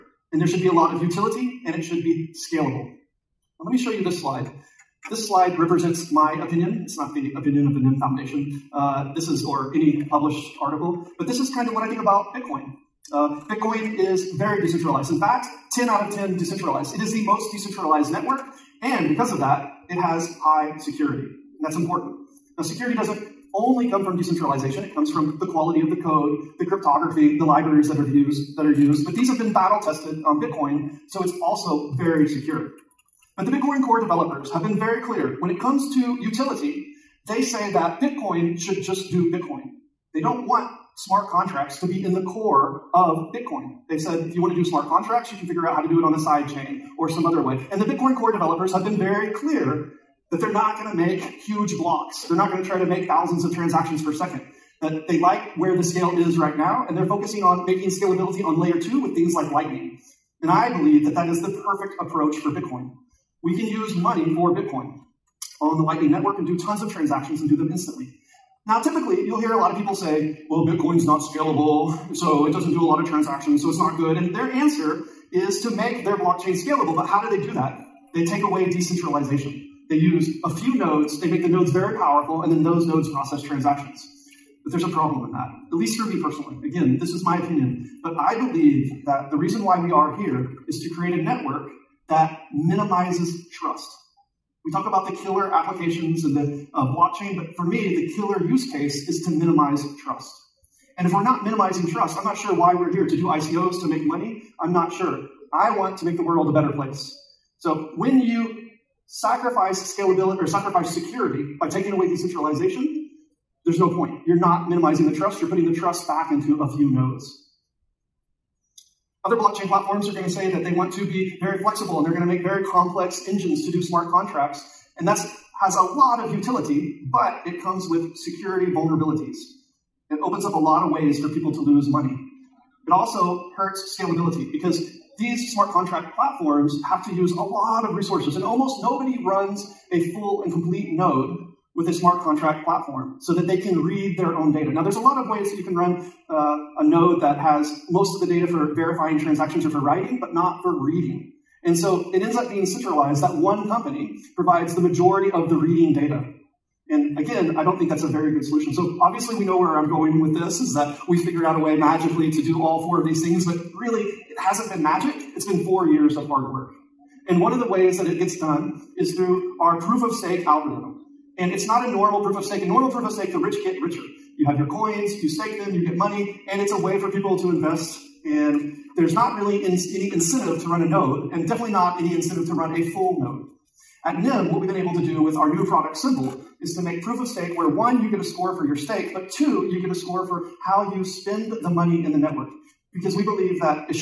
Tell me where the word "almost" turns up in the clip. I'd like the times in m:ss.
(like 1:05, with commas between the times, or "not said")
2:18.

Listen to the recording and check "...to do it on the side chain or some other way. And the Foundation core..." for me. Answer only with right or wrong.
wrong.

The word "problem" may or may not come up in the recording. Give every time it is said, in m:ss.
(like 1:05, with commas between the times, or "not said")
1:24.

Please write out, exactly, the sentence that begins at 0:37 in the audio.
They say that Bitcoin should just do Bitcoin.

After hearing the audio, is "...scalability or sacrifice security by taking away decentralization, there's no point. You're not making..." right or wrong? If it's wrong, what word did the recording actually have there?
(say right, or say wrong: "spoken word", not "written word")
wrong: "minimizing", not "making".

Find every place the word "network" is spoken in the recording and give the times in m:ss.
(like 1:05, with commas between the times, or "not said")
0:18, 1:06, 1:31, 3:12.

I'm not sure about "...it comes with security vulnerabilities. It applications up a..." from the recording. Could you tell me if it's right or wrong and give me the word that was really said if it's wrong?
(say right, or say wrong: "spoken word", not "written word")
wrong: "opens", not "applications".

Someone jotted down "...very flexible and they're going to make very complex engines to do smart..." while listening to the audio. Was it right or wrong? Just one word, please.
right.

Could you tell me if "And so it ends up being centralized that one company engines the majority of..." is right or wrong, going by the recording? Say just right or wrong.
wrong.